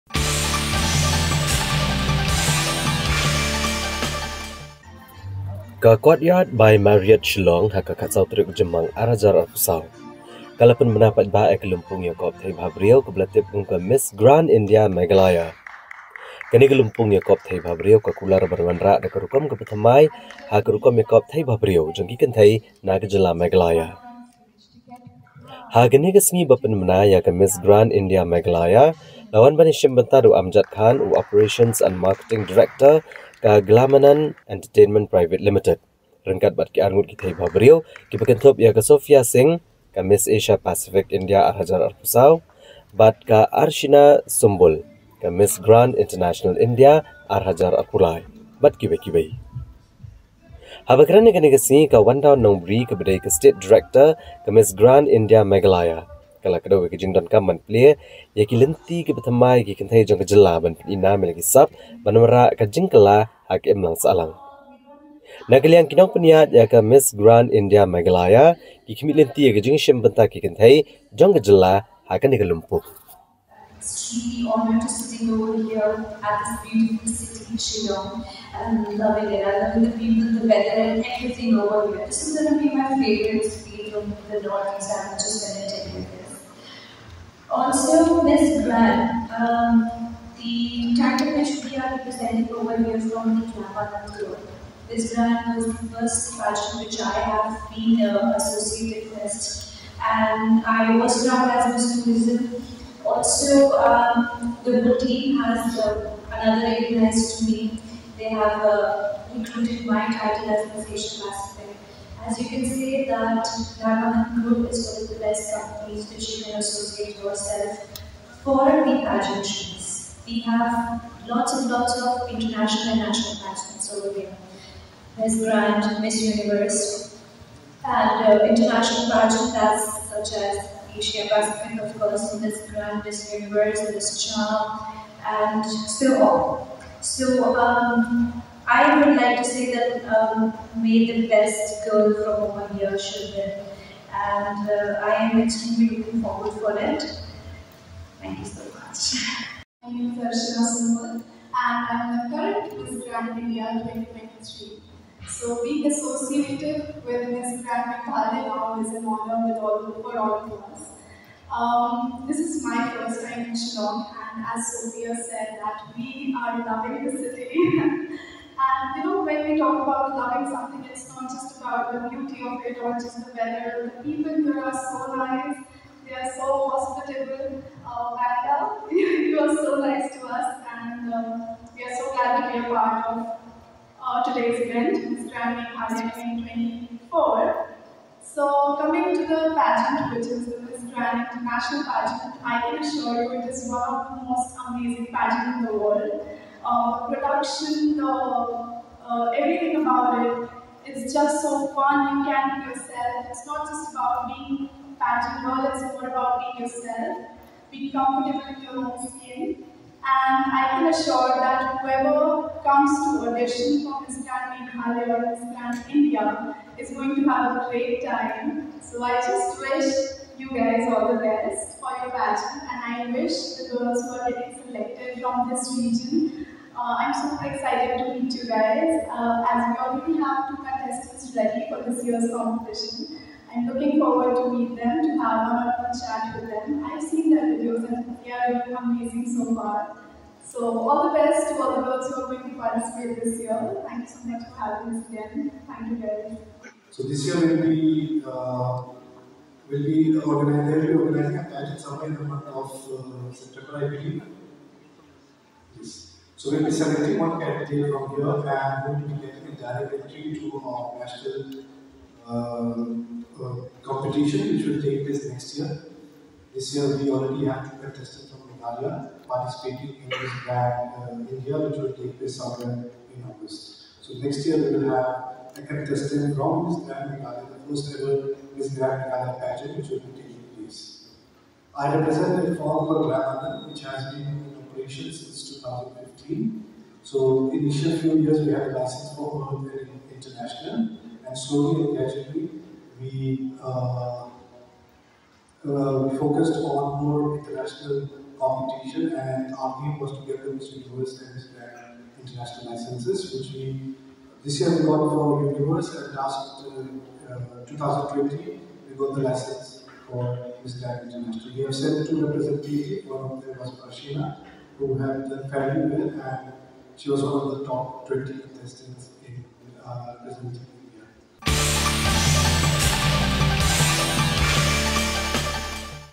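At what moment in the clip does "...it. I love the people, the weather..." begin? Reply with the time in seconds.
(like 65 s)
79 s.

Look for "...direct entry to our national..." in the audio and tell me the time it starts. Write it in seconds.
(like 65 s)
259 s.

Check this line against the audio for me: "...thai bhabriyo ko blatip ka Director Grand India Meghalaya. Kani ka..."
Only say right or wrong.
wrong.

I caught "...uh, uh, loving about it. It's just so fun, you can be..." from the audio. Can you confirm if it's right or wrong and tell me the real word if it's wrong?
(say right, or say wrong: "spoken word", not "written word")
wrong: "everything", not "loving".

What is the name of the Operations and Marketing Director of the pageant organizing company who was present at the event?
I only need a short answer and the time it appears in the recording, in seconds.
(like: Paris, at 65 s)
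Amjad Khan, at 30 s.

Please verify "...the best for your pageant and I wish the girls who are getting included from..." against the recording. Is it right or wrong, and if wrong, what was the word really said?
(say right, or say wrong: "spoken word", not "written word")
wrong: "selected", not "included".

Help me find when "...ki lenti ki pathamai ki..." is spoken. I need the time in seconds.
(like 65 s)
58 s.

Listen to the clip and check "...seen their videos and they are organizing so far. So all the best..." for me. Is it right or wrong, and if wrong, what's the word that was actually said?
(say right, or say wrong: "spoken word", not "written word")
wrong: "amazing", not "organizing".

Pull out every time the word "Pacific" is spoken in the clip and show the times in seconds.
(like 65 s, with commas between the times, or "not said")
40 s, 131 s.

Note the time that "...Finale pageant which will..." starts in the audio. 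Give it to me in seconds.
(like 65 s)
279 s.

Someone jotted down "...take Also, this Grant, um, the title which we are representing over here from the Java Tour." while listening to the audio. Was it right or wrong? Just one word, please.
right.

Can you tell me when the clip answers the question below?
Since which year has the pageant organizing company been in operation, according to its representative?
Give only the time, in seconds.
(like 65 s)
285 s.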